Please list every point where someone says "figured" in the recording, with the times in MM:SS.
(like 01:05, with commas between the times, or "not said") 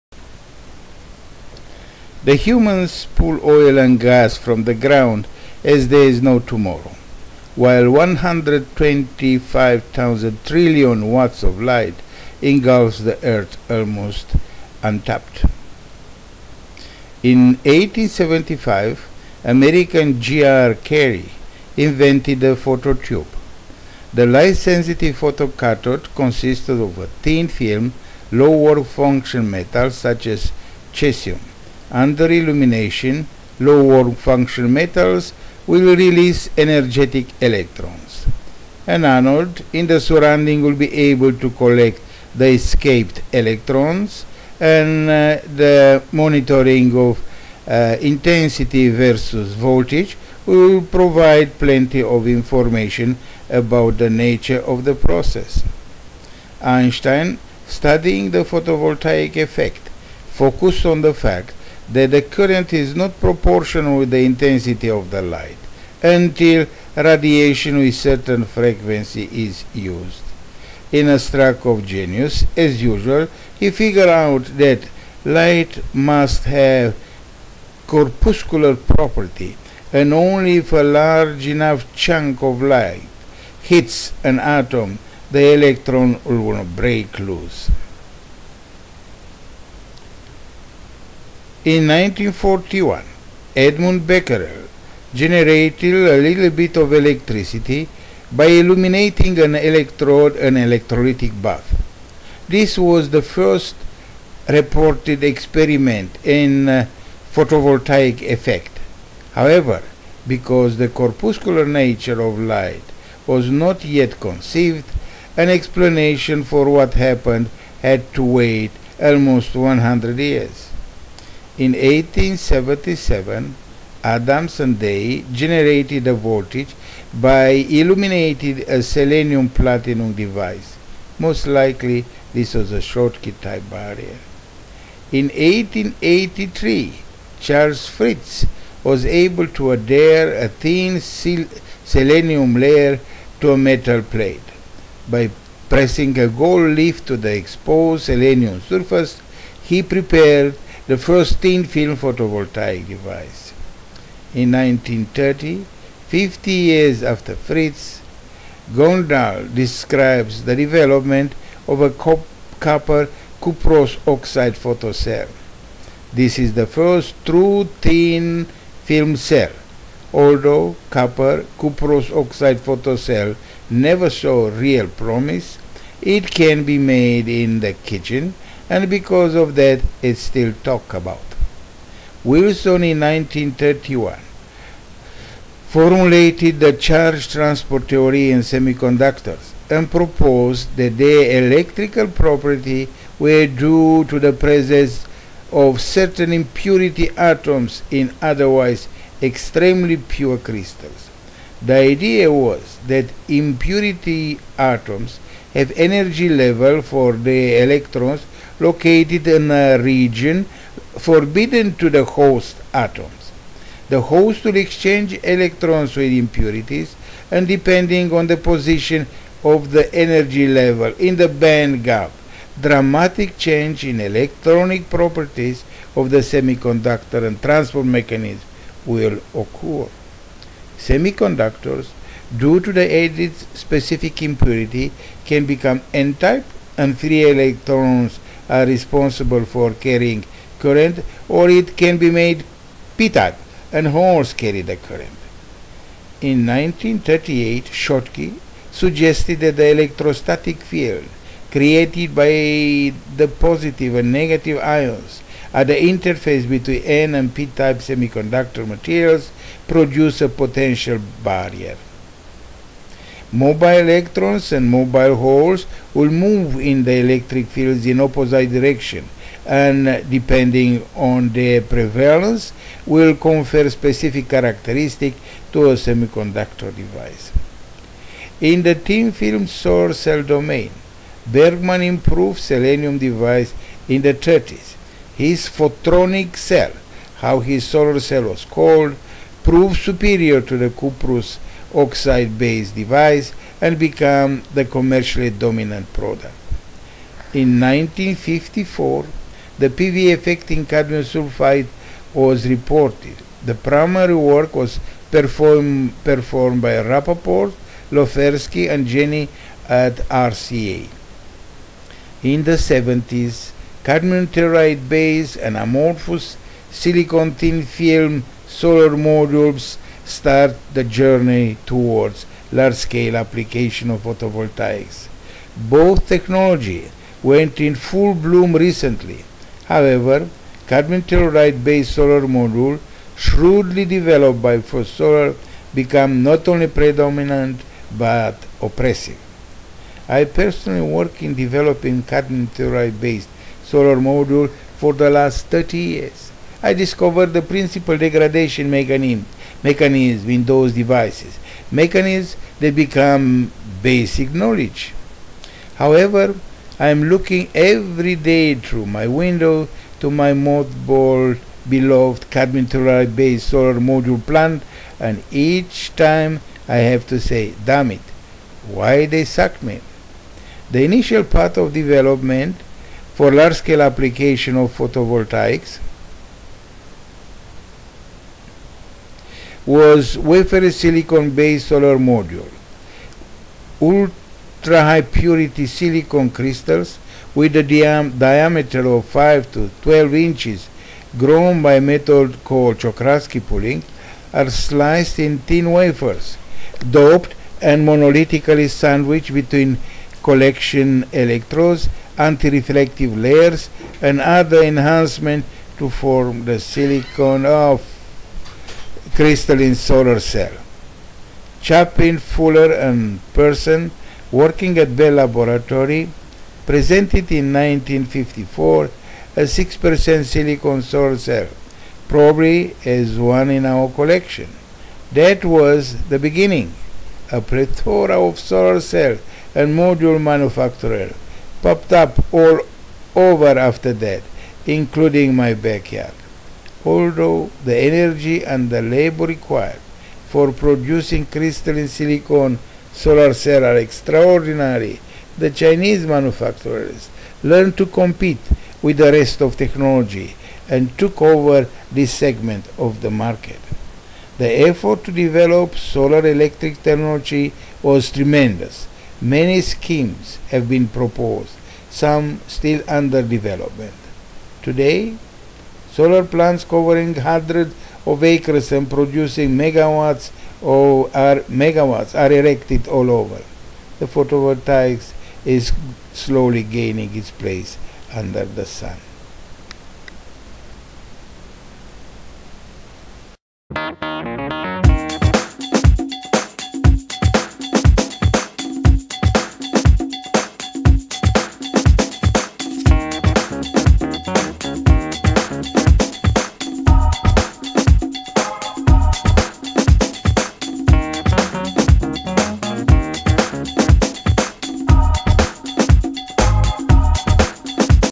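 01:13.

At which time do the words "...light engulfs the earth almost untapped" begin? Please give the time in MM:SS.
00:11.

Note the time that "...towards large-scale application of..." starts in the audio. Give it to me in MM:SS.
05:21.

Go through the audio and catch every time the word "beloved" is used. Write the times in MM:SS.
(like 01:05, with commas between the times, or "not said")
06:01.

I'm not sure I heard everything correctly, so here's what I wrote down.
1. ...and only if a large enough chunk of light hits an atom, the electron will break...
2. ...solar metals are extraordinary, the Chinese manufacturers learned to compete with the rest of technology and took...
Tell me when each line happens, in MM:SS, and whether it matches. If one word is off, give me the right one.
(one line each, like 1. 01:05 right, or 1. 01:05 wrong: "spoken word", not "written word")
1. 01:19 right
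2. 07:22 wrong: "cells", not "metals".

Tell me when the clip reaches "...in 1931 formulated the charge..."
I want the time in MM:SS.
03:02.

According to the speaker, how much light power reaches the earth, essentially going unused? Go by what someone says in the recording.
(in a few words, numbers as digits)
125,000 trillion watts.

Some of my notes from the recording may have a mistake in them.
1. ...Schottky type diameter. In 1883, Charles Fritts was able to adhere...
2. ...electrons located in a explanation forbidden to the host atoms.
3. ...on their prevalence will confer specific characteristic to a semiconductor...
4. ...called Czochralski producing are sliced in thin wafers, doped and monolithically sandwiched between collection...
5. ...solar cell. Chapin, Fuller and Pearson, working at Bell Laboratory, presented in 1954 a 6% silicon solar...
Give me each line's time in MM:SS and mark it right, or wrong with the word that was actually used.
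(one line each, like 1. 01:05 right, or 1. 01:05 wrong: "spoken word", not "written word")
1. 02:12 wrong: "barrier", not "diameter"
2. 03:27 wrong: "region", not "explanation"
3. 04:30 right
4. 06:32 wrong: "pulling", not "producing"
5. 06:49 right.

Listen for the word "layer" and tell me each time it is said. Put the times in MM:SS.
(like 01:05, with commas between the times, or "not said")
02:22, 06:43.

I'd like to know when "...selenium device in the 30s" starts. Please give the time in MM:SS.
04:42.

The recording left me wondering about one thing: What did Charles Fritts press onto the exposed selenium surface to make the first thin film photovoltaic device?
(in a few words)
gold leaf.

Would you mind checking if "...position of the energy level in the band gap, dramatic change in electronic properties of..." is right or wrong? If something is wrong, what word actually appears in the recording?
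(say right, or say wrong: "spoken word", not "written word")
right.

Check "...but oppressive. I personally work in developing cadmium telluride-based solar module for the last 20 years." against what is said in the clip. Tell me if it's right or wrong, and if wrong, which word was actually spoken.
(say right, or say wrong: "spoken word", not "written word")
wrong: "30", not "20".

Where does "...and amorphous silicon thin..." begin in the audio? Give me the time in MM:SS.
05:15.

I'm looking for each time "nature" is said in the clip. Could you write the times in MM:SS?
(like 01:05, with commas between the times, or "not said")
00:54, 01:51.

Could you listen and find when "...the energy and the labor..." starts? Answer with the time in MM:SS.
07:17.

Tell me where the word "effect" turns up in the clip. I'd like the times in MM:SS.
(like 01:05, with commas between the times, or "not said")
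00:59, 01:48, 05:00.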